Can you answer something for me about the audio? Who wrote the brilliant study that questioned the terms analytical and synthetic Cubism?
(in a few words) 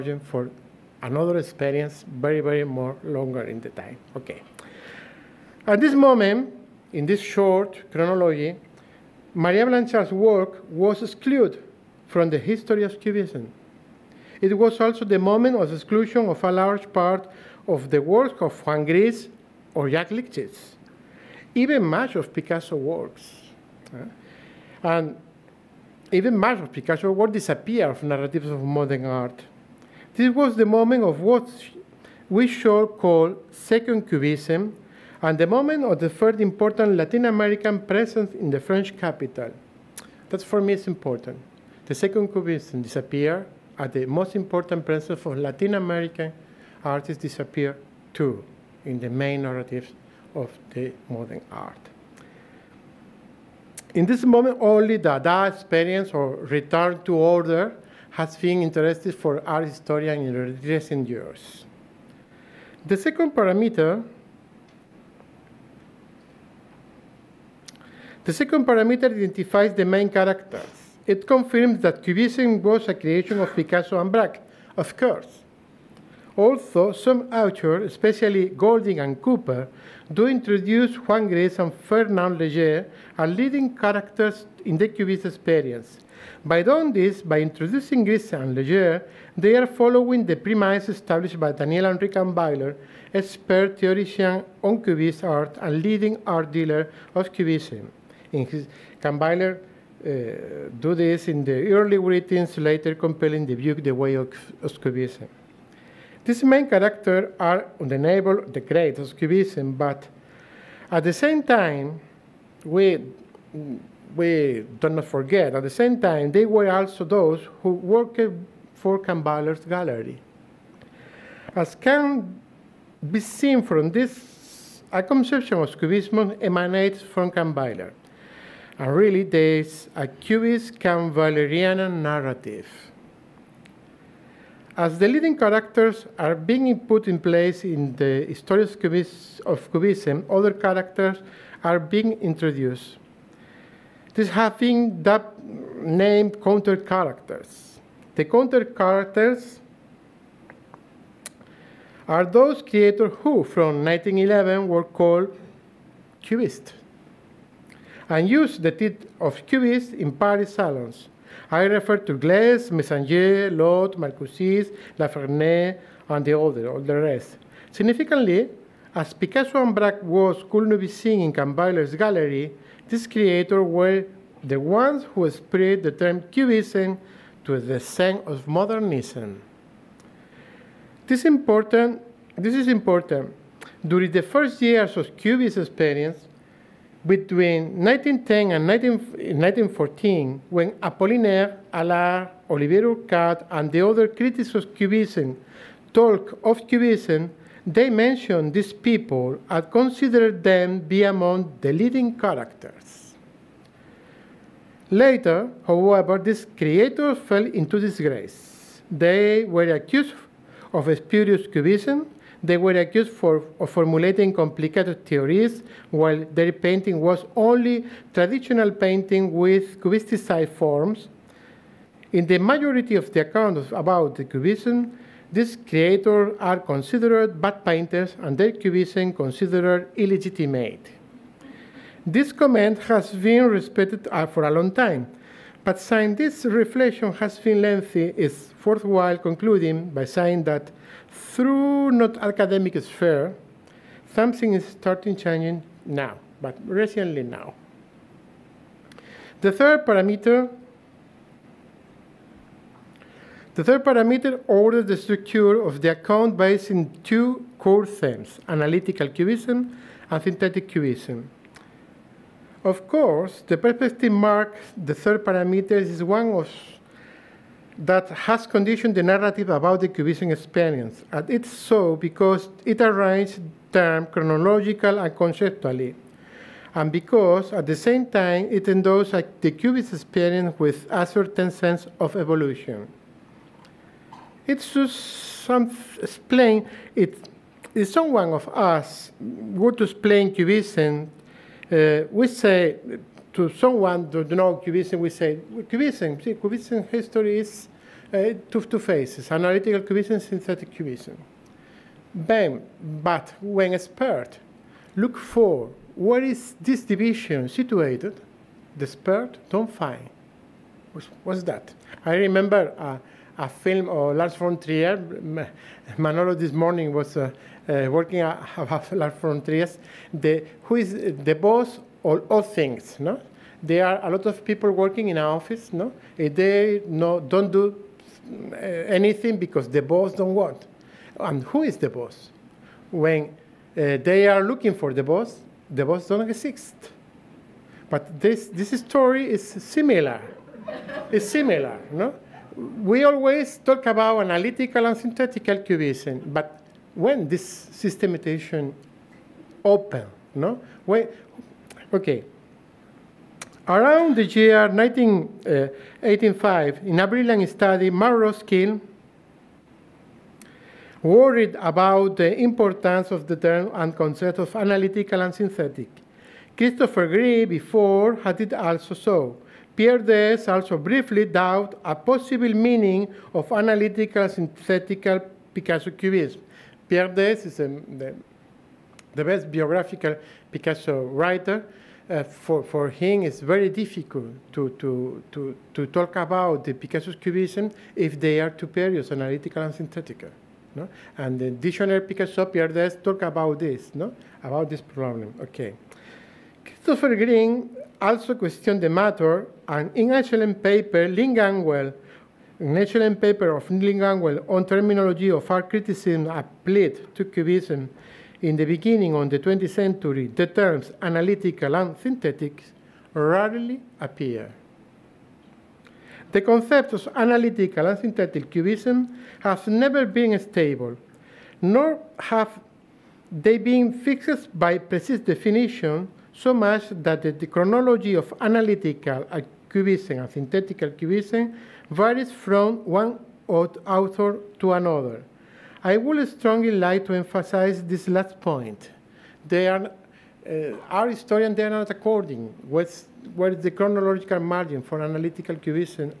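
Mark Roskill.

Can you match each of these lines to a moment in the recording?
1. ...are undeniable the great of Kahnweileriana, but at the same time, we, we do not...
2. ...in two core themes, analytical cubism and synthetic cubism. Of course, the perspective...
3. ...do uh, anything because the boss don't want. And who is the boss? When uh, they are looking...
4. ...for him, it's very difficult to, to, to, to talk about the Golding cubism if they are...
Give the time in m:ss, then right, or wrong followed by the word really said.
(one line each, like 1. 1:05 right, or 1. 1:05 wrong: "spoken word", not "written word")
1. 1:47 wrong: "Cubism", not "Kahnweileriana"
2. 4:16 right
3. 5:27 right
4. 6:22 wrong: "Picasso", not "Golding".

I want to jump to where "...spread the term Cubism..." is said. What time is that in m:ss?
2:55.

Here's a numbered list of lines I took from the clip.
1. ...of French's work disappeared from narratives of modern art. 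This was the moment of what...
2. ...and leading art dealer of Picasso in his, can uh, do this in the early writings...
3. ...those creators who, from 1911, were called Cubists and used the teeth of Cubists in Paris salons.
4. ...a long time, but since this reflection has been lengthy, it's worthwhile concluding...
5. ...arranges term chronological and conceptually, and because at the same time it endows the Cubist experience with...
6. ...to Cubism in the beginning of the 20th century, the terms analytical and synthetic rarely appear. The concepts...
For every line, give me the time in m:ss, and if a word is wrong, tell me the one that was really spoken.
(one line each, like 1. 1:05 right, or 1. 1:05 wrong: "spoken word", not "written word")
1. 0:26 wrong: "Picasso", not "French"
2. 1:35 wrong: "Cubism", not "Picasso"
3. 2:32 right
4. 3:54 right
5. 4:32 right
6. 6:47 right.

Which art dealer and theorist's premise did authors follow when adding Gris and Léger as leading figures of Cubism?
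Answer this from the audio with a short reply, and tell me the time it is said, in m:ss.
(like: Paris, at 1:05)
Daniel Kahnweiler, at 1:31.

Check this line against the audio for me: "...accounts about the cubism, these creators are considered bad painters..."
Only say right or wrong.
right.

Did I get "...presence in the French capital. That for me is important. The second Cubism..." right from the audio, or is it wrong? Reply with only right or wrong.
right.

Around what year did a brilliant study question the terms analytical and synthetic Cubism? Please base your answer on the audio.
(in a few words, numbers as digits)
1985.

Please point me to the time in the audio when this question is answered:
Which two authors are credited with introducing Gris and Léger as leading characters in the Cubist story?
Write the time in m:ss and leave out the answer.
1:18.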